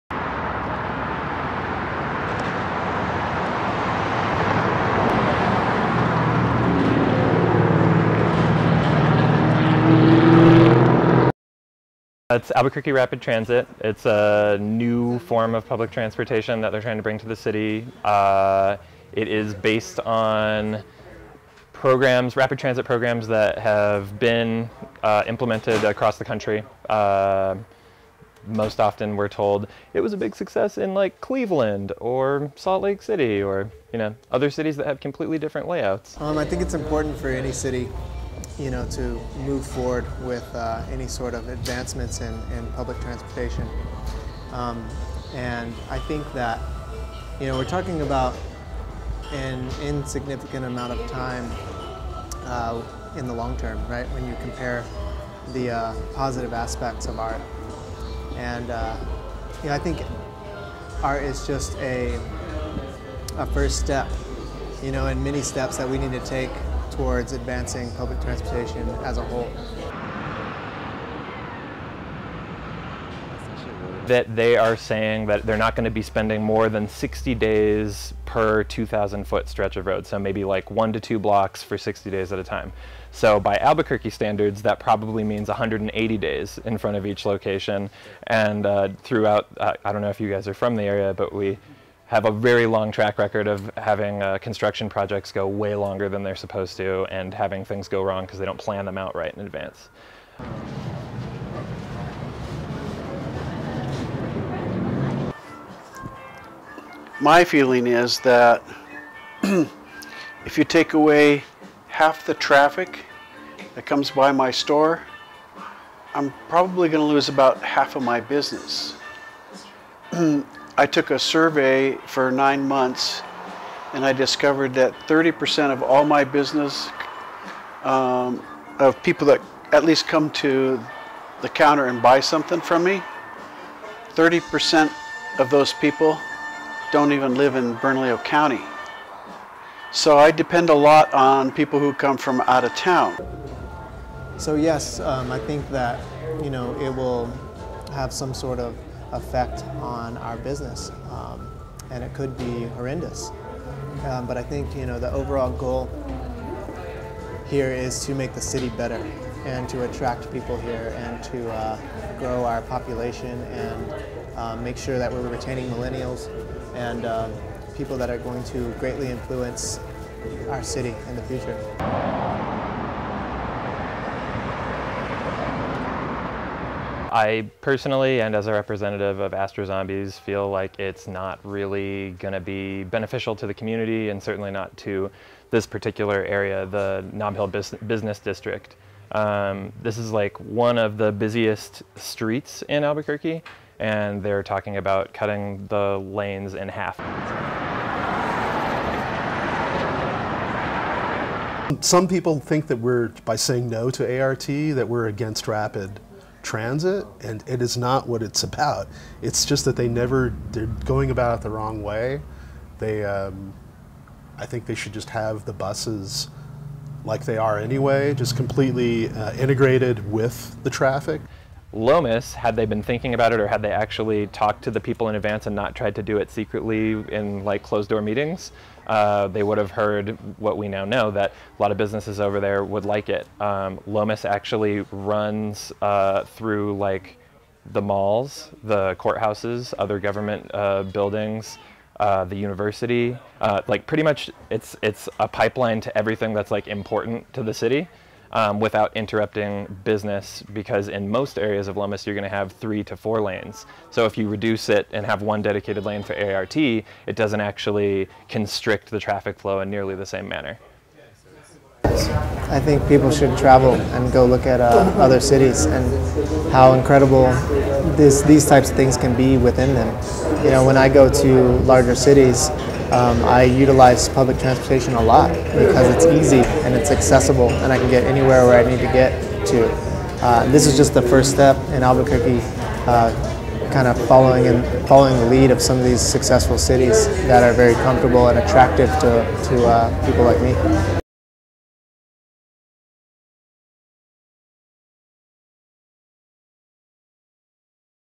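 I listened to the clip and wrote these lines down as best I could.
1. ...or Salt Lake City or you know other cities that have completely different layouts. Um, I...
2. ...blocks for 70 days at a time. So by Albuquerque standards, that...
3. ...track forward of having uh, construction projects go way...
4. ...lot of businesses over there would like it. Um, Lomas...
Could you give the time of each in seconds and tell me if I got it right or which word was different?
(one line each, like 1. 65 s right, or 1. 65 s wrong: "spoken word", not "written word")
1. 31 s right
2. 81 s wrong: "60", not "70"
3. 92 s wrong: "record", not "forward"
4. 231 s right.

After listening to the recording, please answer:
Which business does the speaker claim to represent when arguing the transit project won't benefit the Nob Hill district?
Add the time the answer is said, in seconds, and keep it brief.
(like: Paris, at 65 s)
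Astro Zombies, at 179 s.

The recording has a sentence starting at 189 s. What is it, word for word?
Um, this is like one of the busiest streets in Albuquerque, and they're talking about cutting the lanes in half.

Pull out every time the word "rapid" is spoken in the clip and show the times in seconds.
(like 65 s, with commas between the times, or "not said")
12 s, 22 s, 205 s.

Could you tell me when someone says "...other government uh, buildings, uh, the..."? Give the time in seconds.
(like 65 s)
239 s.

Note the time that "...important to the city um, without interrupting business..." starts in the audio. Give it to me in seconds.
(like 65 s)
246 s.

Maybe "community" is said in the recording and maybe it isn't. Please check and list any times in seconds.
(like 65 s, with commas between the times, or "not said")
183 s.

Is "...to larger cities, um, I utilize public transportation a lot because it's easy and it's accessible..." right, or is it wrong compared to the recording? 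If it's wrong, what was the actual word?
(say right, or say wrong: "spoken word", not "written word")
right.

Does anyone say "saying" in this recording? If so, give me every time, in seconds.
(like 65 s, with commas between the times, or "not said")
74 s, 203 s.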